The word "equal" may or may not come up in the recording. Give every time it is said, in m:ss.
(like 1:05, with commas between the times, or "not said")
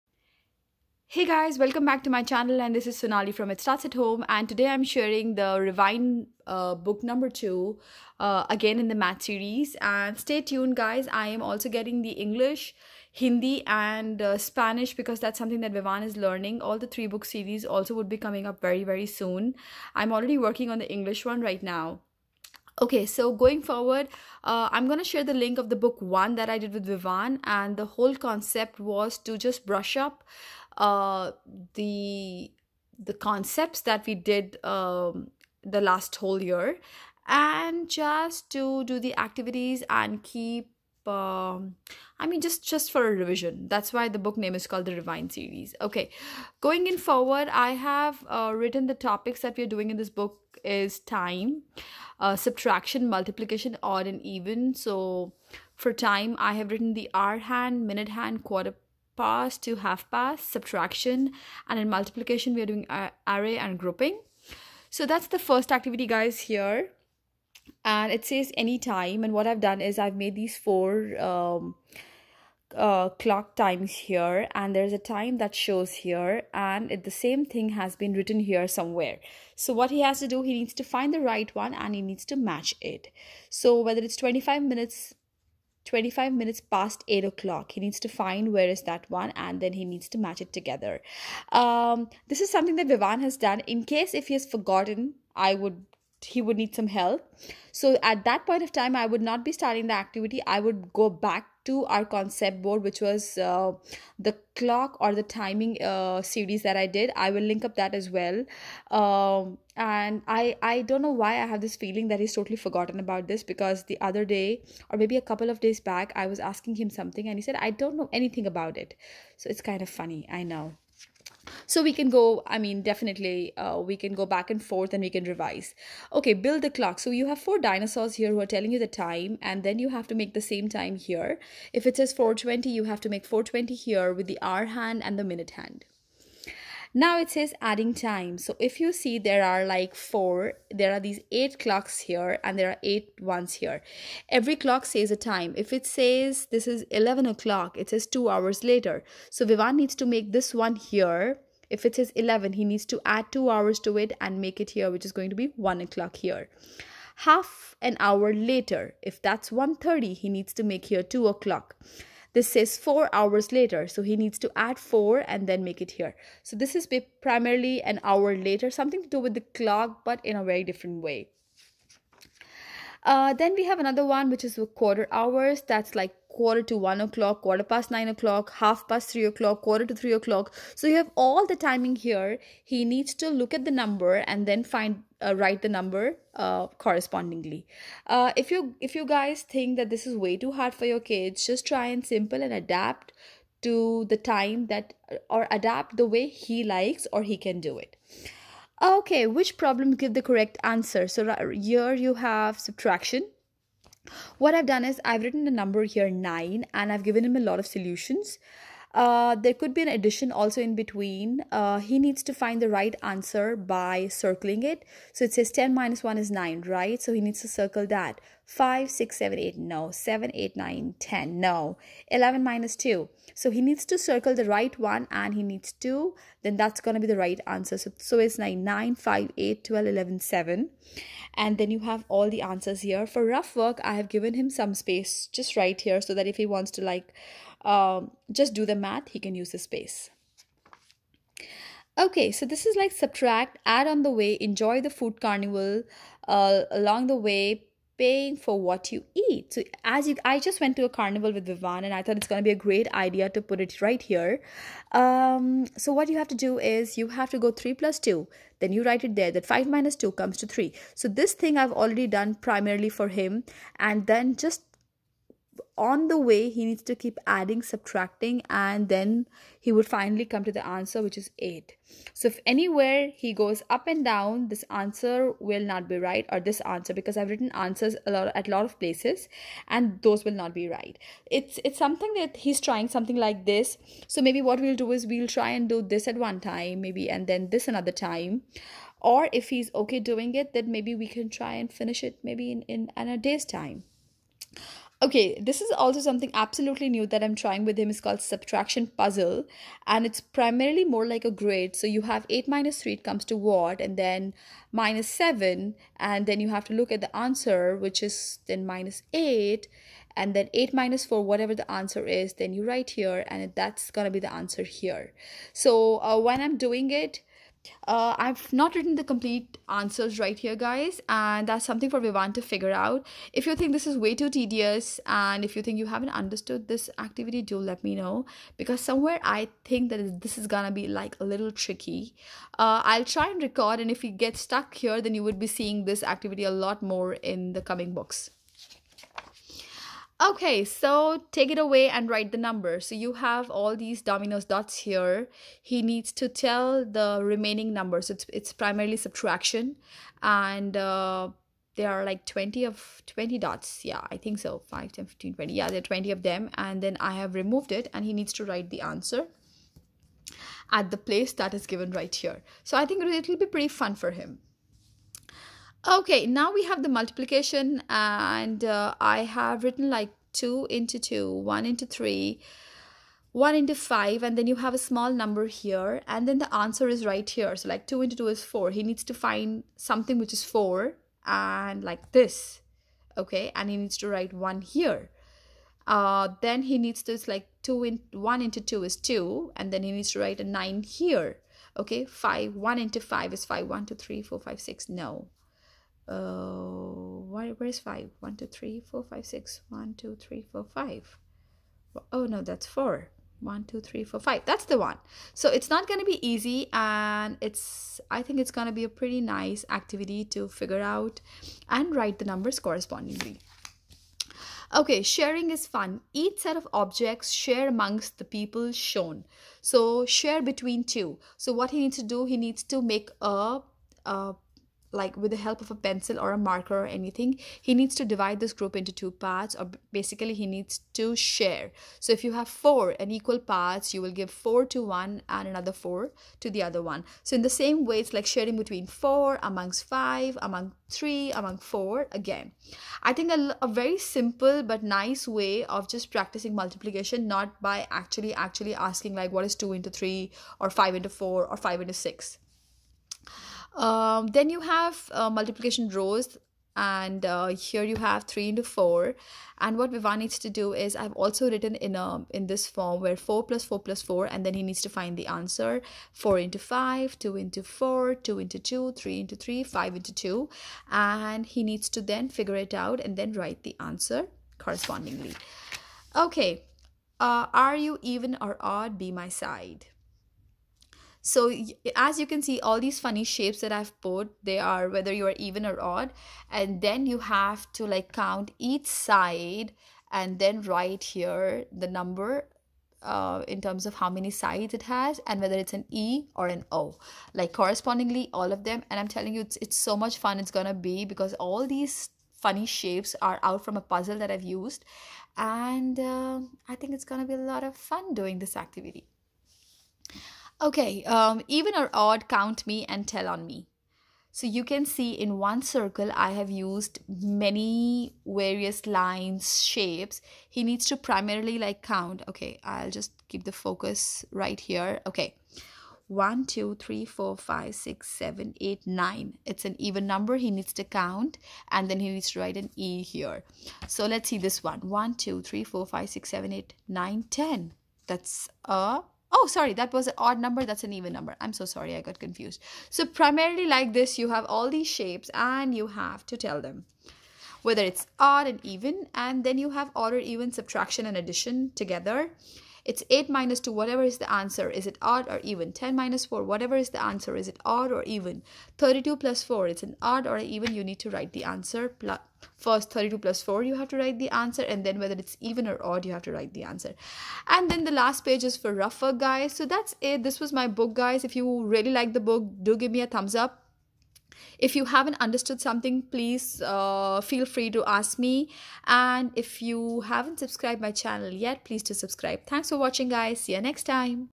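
7:13.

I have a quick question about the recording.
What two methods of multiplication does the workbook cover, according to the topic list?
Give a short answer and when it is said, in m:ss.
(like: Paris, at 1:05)
Array and grouping, at 1:03.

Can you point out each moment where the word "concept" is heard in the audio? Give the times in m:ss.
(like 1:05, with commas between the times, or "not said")
0:28, 0:33, 1:42.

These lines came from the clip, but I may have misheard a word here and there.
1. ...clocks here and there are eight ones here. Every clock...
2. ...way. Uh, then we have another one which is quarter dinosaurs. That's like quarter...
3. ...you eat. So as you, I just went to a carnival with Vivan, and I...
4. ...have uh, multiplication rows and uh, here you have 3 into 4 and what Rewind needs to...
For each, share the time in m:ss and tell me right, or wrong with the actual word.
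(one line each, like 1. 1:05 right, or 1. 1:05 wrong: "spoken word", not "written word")
1. 2:21 right
2. 2:51 wrong: "hours", not "dinosaurs"
3. 4:08 right
4. 7:34 wrong: "Vivan", not "Rewind".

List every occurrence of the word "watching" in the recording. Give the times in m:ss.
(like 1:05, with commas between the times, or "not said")
9:42.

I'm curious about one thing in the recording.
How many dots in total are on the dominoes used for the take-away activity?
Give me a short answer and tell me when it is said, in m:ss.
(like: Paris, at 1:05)
20, at 5:53.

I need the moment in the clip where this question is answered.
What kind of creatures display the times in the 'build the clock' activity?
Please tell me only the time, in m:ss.
2:07.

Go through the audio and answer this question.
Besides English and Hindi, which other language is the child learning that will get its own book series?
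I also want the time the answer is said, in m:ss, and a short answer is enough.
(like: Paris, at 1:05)
Spanish, at 0:14.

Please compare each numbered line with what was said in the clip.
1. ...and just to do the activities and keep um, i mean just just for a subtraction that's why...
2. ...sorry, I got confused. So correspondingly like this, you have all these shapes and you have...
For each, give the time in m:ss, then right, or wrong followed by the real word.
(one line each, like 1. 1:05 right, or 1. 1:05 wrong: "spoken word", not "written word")
1. 0:37 wrong: "revision", not "subtraction"
2. 9:01 wrong: "primarily", not "correspondingly".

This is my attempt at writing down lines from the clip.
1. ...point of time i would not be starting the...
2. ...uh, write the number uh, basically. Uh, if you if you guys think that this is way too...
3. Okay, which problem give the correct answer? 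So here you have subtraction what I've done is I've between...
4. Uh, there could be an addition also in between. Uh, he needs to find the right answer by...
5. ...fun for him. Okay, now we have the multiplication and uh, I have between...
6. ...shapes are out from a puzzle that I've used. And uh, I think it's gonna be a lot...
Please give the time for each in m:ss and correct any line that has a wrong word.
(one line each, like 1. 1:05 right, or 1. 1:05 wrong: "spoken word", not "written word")
1. 1:38 right
2. 3:05 wrong: "correspondingly", not "basically"
3. 3:18 wrong: "written", not "between"
4. 3:28 right
5. 6:03 wrong: "written", not "between"
6. 8:22 right.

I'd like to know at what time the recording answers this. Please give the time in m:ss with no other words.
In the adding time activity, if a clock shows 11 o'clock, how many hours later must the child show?
2:28.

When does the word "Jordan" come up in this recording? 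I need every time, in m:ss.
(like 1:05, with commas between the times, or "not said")
not said.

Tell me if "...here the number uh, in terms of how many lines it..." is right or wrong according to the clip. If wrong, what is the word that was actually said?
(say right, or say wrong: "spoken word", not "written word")
wrong: "sides", not "lines".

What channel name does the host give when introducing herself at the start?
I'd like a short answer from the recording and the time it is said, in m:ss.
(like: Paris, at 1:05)
It Starts at Home, at 0:03.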